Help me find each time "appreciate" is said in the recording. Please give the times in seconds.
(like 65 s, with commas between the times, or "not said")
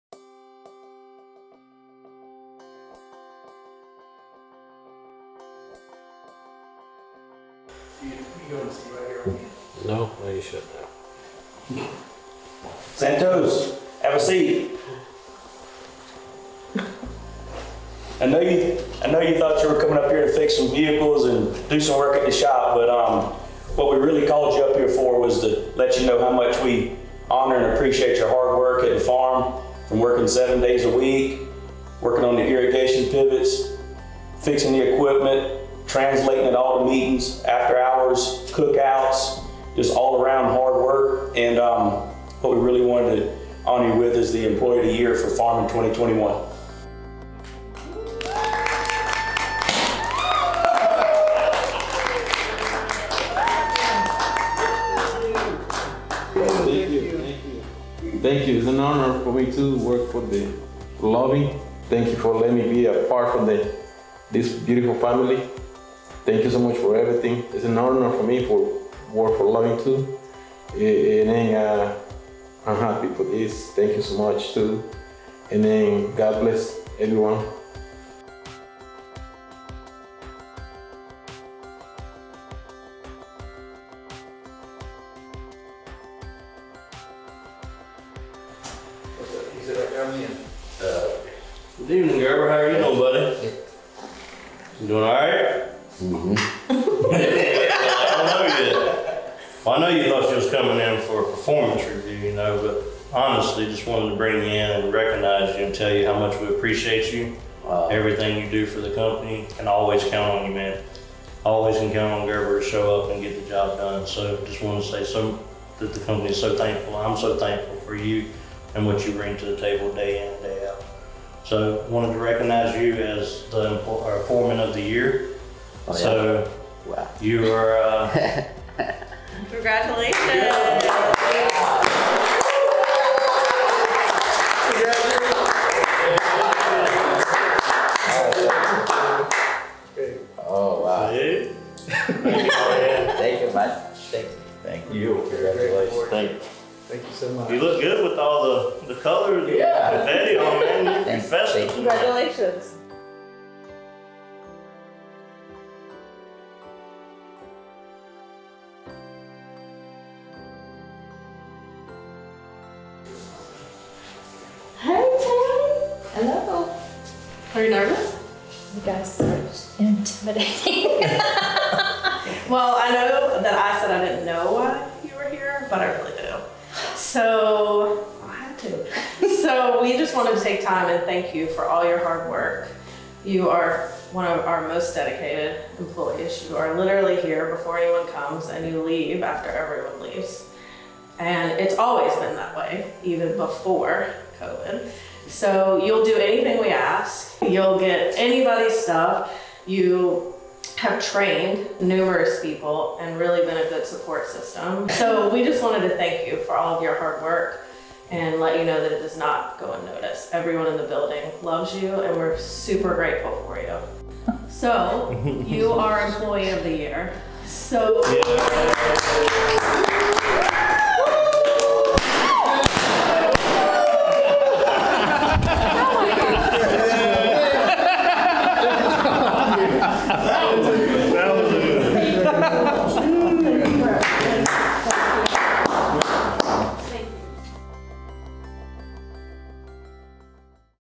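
27 s, 106 s.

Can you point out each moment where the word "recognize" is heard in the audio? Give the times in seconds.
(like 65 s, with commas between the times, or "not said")
104 s, 122 s.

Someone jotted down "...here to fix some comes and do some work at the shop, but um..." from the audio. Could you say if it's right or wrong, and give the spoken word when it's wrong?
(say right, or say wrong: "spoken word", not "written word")
wrong: "vehicles", not "comes".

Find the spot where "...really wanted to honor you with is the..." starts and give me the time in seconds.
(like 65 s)
42 s.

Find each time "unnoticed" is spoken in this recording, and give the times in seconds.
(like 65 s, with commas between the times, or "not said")
209 s.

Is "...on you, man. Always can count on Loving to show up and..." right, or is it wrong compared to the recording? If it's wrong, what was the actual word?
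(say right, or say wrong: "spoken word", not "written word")
wrong: "Gerber", not "Loving".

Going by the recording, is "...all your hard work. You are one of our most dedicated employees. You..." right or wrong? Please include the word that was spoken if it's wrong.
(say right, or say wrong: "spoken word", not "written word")
right.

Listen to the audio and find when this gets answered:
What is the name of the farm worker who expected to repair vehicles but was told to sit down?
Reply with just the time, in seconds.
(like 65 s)
12 s.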